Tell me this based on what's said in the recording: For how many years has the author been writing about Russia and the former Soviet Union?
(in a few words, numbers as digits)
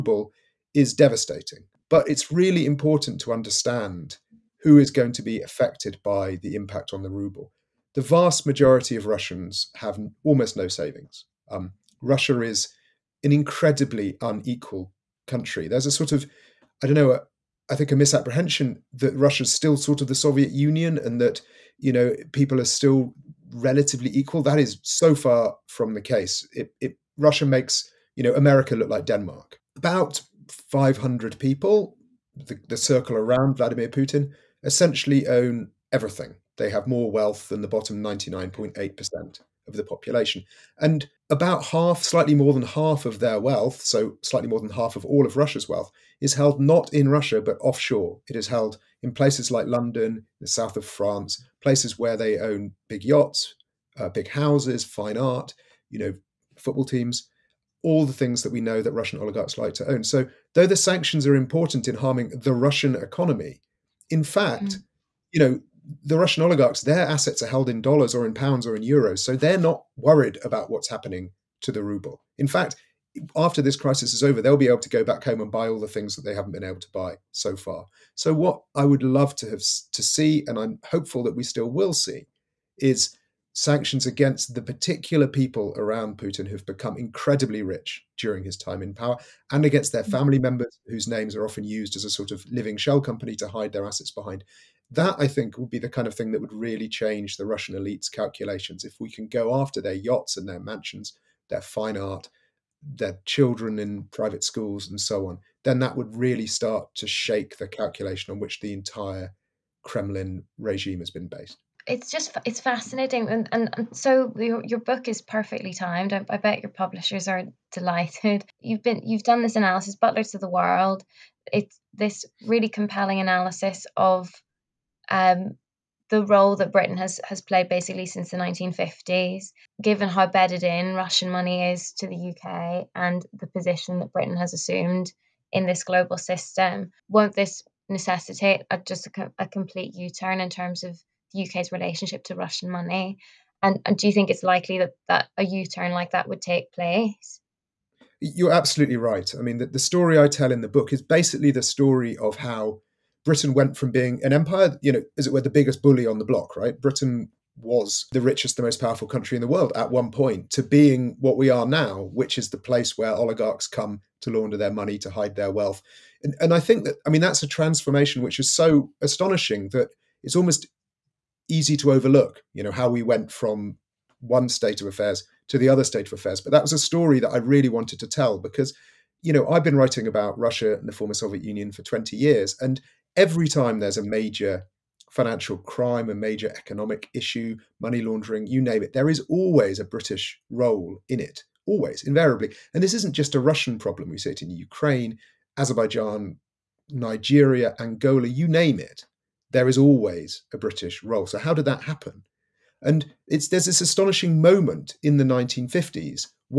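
20 years.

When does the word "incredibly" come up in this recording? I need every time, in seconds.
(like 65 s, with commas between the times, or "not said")
13 s, 86 s.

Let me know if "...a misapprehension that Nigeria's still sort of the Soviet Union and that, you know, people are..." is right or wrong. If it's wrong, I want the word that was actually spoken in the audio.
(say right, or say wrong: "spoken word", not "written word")
wrong: "Russia", not "Nigeria".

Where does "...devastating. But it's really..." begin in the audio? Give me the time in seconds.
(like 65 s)
0 s.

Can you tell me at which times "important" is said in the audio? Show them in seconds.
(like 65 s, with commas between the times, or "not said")
2 s, 61 s.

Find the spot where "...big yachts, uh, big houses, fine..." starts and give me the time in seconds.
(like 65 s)
52 s.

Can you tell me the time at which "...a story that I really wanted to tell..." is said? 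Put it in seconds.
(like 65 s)
176 s.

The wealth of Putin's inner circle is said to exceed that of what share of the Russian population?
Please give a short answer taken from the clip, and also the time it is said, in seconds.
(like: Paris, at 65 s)
bottom 99.8%, at 37 s.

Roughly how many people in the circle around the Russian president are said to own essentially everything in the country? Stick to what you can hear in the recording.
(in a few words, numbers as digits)
500.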